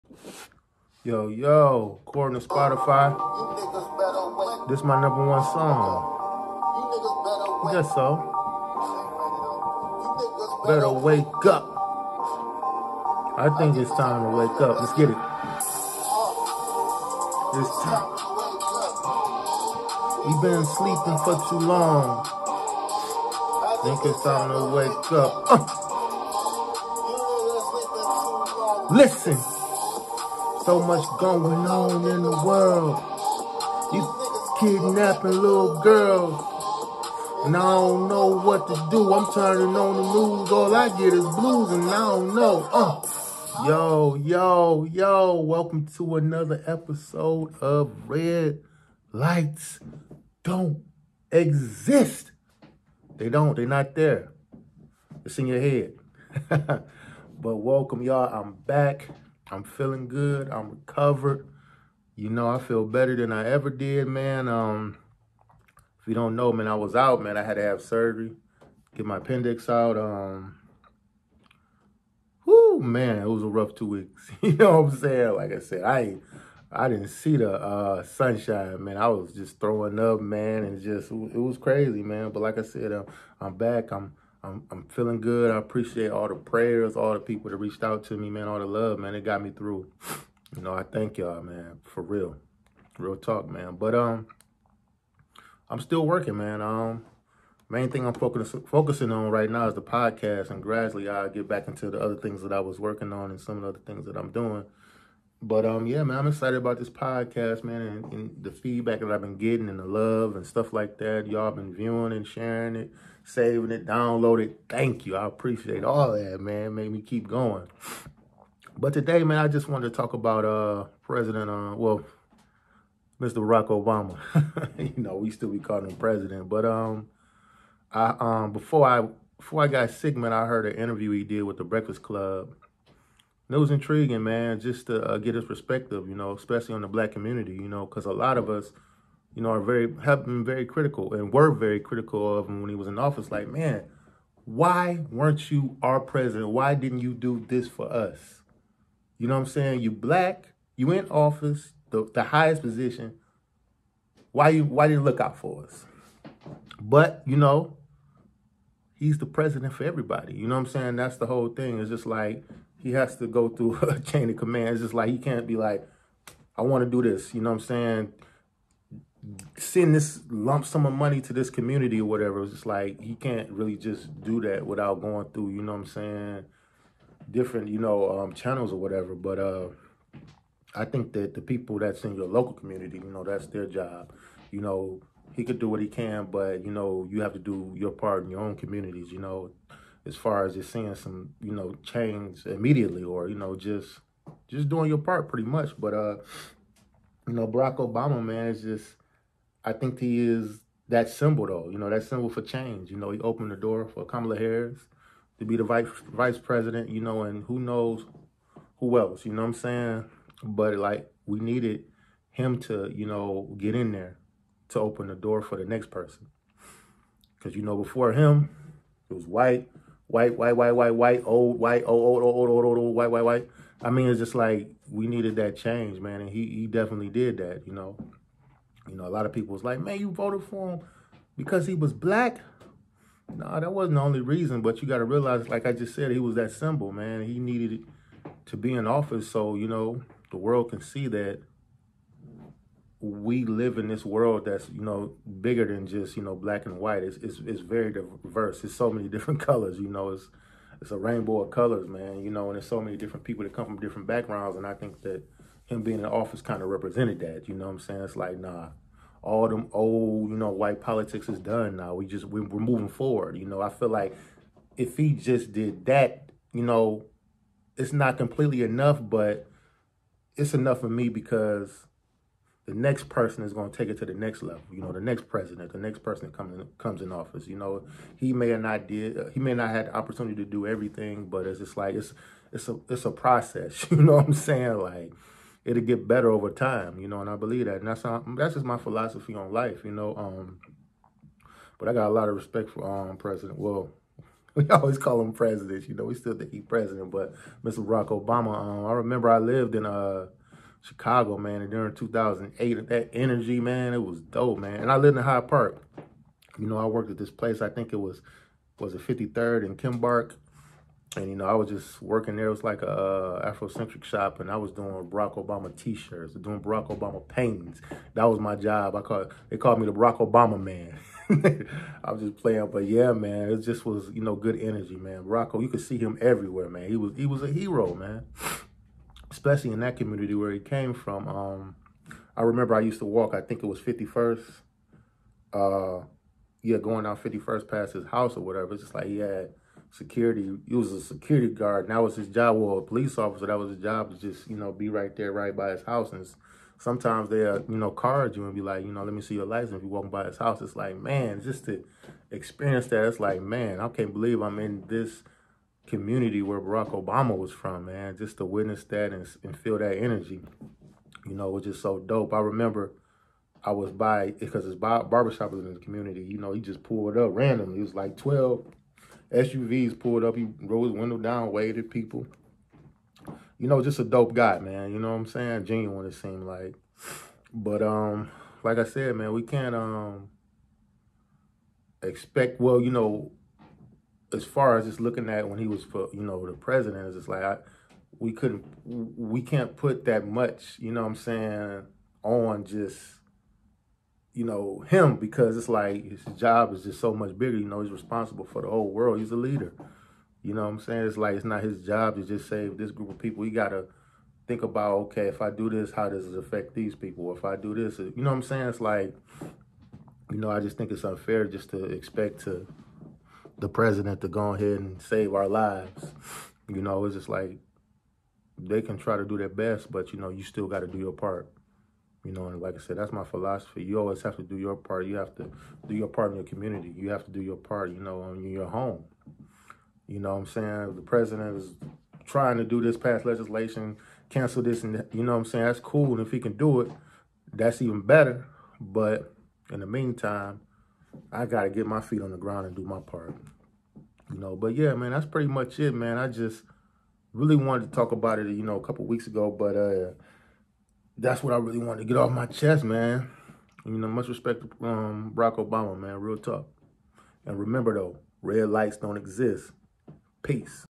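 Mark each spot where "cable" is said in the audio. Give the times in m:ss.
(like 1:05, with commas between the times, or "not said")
not said.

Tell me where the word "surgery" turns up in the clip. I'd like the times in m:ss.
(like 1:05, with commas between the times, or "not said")
1:07.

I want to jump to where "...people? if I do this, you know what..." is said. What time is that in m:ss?
6:46.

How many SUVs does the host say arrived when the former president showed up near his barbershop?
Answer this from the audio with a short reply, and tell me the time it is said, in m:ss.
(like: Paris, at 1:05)
12, at 6:08.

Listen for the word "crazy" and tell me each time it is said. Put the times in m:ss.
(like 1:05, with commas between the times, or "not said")
1:21.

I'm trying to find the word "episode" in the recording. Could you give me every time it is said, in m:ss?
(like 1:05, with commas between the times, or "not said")
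0:46.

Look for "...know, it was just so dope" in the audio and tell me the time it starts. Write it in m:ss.
6:01.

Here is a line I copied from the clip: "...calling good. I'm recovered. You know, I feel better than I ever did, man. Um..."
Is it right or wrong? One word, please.
wrong.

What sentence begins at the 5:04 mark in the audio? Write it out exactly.
And I lived in Hyde Park.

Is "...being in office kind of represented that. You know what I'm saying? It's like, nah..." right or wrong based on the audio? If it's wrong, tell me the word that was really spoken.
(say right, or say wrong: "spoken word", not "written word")
right.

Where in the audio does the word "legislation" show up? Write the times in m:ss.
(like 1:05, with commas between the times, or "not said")
7:13.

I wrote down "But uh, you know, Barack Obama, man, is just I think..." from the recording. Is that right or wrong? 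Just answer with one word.
right.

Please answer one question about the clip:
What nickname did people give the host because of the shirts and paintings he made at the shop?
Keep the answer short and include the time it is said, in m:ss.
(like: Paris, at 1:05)
the Barack Obama man, at 5:19.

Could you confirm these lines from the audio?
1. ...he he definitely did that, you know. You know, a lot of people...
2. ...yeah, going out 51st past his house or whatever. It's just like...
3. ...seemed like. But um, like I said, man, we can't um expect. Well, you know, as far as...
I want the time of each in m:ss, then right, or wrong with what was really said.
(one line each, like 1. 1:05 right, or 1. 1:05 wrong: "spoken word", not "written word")
1. 3:46 right
2. 5:36 right
3. 6:16 right.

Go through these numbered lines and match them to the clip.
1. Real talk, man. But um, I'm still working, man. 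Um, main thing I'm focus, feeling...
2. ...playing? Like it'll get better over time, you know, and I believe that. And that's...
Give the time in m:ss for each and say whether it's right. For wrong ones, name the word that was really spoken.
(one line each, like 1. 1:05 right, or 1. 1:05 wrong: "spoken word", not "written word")
1. 1:32 wrong: "focusing", not "feeling"
2. 4:44 wrong: "saying", not "playing".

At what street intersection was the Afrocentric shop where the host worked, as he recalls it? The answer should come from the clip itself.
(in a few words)
53rd and Kimbark.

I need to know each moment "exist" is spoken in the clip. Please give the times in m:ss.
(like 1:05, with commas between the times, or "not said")
0:51, 7:39.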